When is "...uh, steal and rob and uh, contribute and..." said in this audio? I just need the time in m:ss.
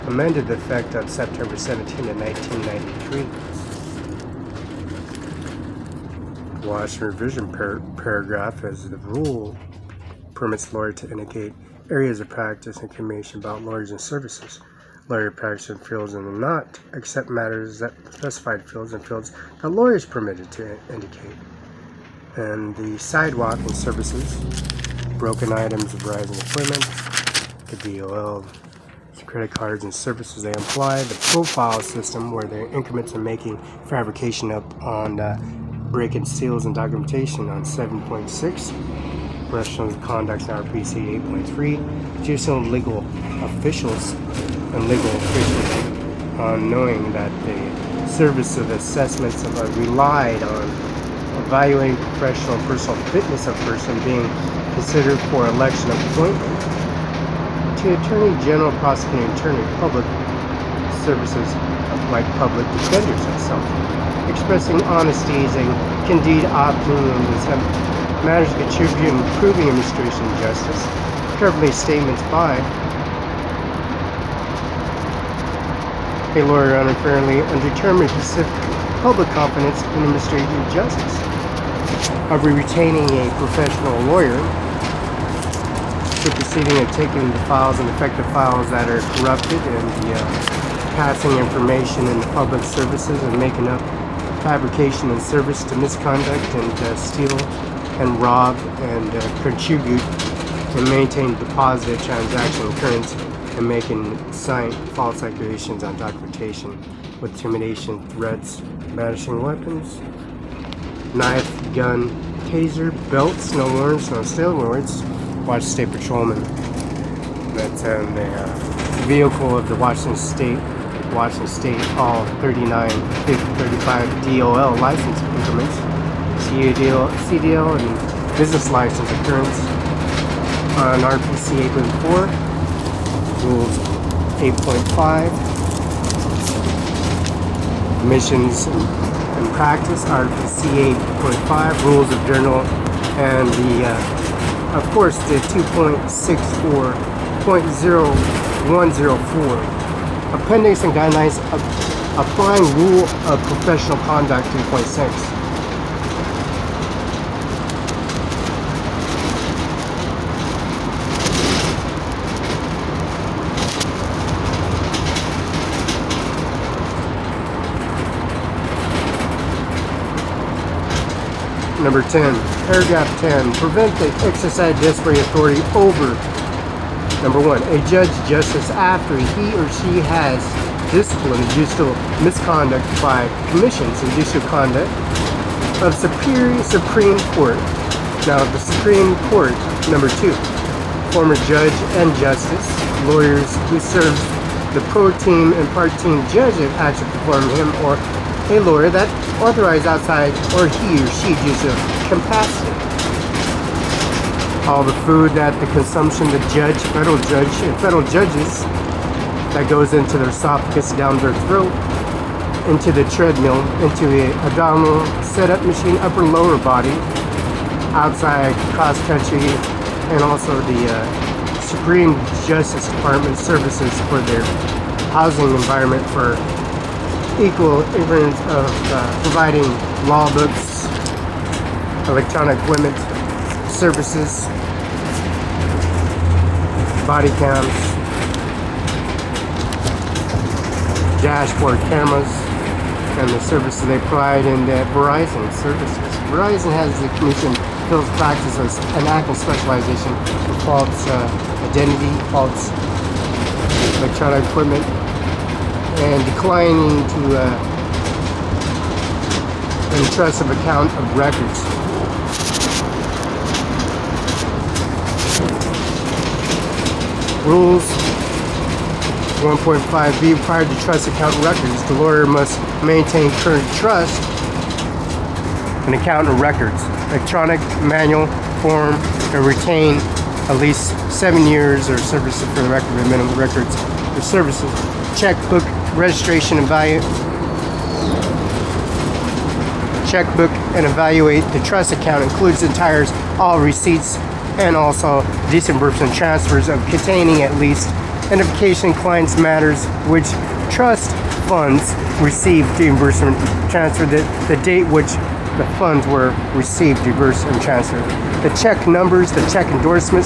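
1:36.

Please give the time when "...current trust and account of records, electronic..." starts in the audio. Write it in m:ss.
4:33.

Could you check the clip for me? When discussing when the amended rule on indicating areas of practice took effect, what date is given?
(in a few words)
September 17, 1993.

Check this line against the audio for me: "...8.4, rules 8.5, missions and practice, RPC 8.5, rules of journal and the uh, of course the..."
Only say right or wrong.
right.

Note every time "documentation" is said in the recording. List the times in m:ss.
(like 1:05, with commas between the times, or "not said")
0:36, 1:45.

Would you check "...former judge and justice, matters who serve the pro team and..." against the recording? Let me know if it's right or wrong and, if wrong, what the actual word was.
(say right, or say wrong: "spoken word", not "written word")
wrong: "lawyers", not "matters".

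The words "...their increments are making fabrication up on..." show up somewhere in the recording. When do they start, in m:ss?
0:32.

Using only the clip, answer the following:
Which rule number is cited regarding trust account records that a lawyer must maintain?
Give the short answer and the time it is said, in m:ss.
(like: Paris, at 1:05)
1.5b, at 4:29.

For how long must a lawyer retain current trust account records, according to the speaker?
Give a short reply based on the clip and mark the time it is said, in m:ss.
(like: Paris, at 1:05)
7 years, at 4:41.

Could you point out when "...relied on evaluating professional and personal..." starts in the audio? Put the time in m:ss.
0:49.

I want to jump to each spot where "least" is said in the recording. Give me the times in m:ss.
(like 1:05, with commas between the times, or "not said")
4:40, 4:57.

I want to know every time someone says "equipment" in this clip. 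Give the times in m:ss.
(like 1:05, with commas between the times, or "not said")
3:52, 4:14.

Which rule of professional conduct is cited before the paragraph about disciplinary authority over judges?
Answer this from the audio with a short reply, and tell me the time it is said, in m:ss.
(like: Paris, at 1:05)
3.6, at 2:34.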